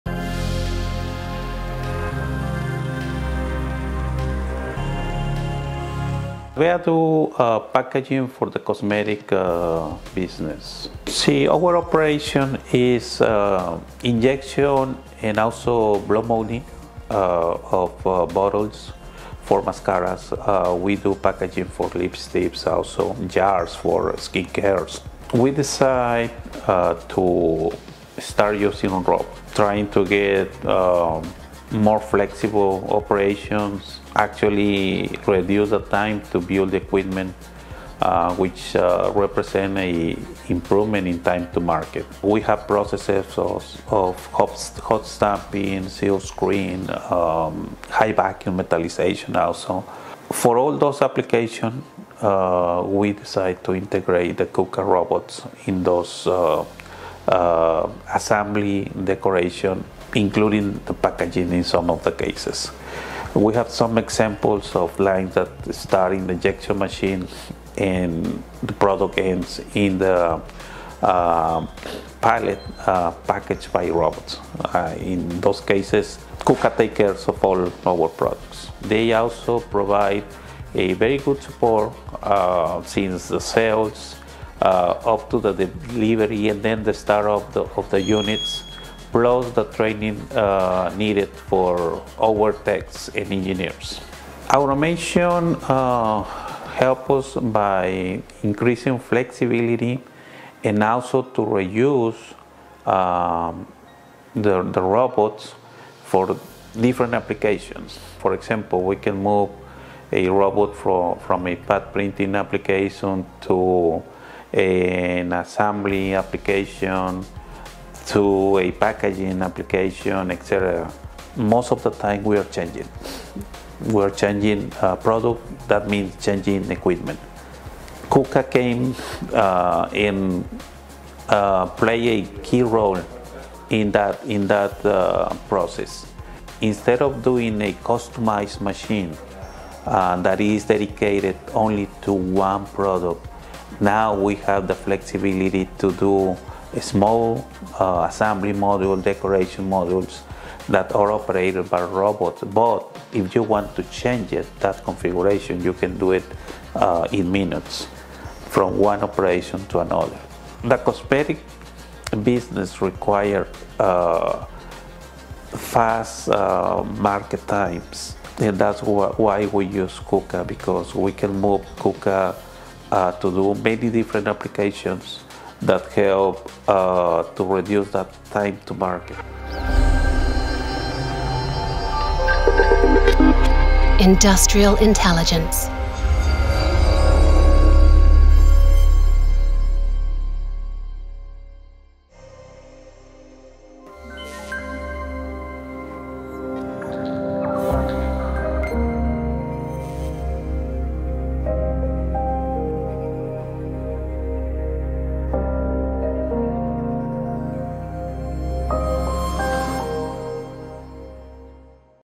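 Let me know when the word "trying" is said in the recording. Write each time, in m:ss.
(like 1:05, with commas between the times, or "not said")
0:29.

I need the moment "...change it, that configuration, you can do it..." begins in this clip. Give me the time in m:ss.
2:33.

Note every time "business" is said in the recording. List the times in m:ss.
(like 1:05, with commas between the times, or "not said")
0:10, 2:42.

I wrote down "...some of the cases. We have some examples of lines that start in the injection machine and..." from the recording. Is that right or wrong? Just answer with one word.
right.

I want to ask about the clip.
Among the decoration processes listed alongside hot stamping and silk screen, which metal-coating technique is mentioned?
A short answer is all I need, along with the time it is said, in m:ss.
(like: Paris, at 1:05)
high vacuum metallization, at 0:47.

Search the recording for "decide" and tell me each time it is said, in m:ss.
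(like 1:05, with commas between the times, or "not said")
0:25, 0:53.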